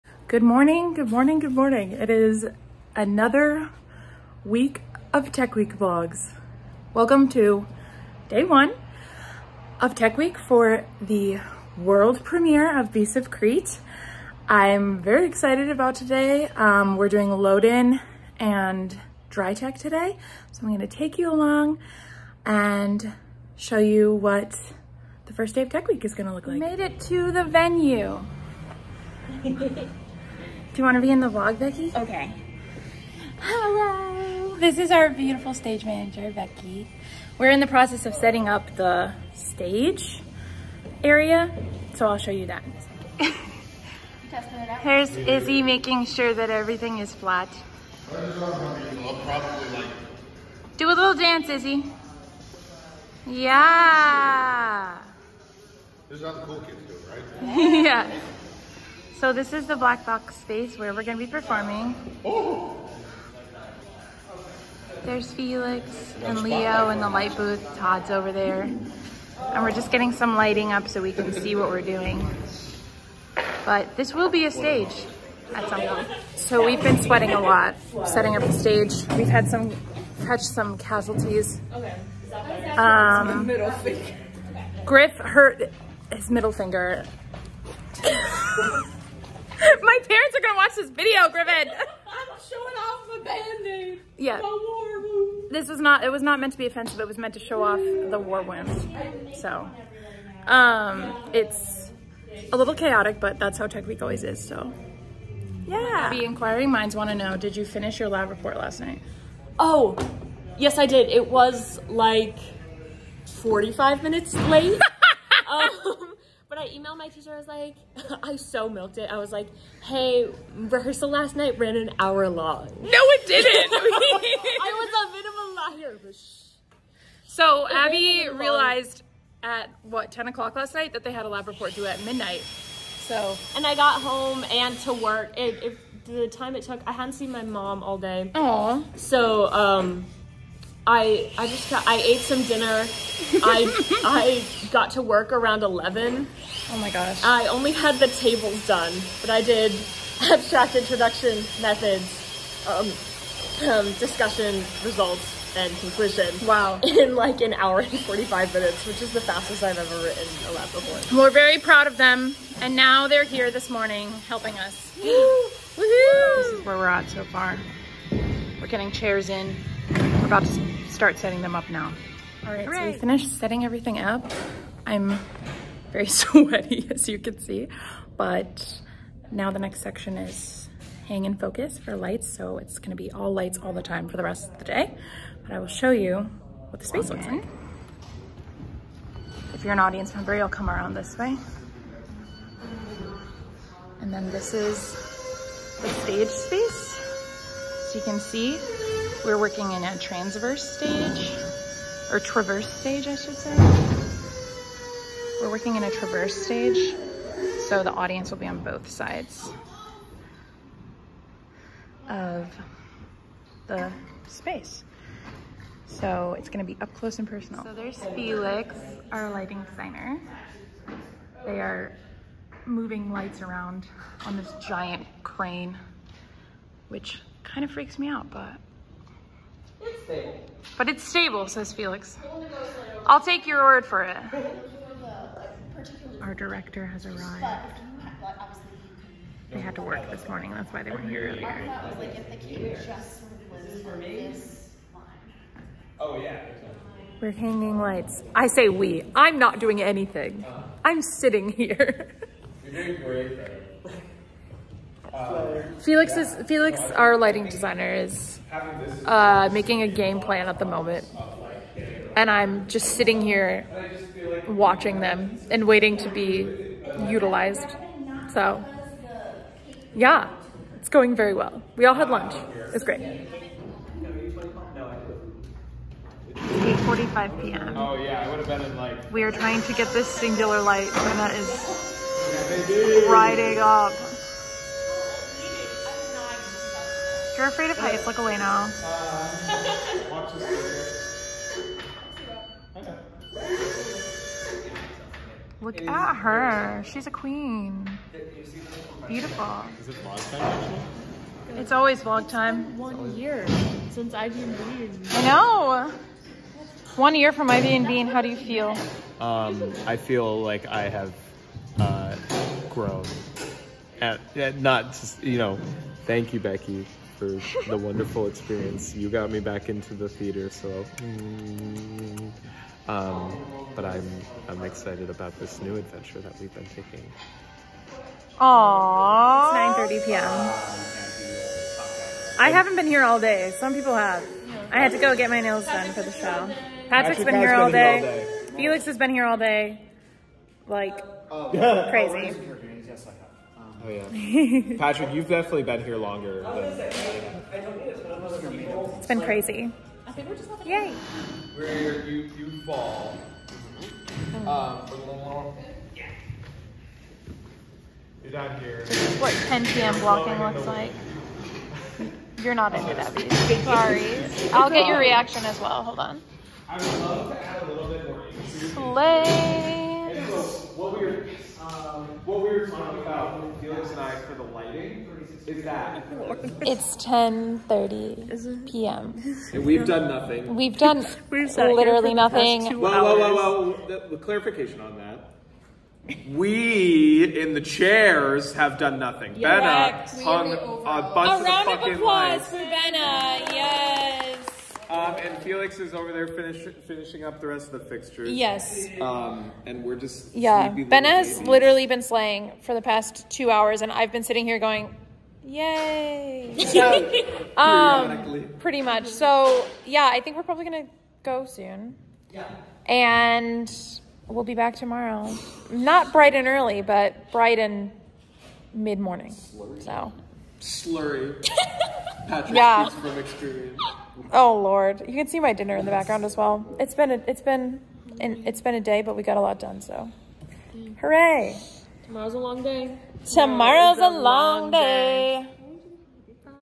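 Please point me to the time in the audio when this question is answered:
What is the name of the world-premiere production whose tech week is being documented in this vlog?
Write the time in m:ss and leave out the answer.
0:12.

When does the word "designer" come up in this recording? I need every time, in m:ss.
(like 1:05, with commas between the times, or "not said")
3:39, 4:17.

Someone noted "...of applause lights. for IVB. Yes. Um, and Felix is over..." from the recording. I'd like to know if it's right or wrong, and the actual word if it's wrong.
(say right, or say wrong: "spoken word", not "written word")
wrong: "Benna", not "IVB".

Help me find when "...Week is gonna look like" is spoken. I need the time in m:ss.
0:25.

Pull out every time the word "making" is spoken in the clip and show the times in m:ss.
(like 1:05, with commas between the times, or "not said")
0:45, 4:19.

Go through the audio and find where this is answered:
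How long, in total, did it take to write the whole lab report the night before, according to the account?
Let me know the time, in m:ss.
2:37.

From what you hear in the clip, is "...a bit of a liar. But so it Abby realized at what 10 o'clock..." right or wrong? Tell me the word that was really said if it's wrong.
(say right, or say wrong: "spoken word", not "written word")
right.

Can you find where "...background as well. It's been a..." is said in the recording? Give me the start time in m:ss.
7:05.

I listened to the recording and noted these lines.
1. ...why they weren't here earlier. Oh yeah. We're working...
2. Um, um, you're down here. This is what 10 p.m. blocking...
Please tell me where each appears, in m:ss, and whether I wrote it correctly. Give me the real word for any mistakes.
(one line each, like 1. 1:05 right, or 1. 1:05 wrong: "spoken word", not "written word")
1. 4:00 wrong: "hanging", not "working"
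2. 5:54 right.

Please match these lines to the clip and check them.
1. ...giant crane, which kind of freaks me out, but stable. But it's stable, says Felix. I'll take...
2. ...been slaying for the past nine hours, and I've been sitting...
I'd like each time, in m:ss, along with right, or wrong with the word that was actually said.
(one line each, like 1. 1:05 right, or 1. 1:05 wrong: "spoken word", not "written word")
1. 3:44 right
2. 6:41 wrong: "two", not "nine".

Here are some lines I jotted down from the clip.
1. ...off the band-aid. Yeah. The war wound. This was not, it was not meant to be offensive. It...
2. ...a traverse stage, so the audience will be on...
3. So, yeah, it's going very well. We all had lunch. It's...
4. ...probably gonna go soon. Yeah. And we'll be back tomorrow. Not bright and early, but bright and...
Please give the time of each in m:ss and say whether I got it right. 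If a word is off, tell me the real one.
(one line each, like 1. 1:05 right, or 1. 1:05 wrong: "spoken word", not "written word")
1. 1:32 right
2. 3:25 right
3. 4:28 right
4. 6:50 right.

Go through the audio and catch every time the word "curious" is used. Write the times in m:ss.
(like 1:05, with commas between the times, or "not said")
not said.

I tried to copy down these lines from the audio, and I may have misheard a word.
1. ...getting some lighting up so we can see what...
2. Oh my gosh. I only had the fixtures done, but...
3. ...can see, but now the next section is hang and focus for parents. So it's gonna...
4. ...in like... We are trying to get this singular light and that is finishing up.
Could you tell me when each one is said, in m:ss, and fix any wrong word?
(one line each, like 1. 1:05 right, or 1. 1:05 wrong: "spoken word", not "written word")
1. 1:09 right
2. 2:26 wrong: "tables", not "fixtures"
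3. 2:57 wrong: "lights", not "parents"
4. 4:38 wrong: "riding", not "finishing".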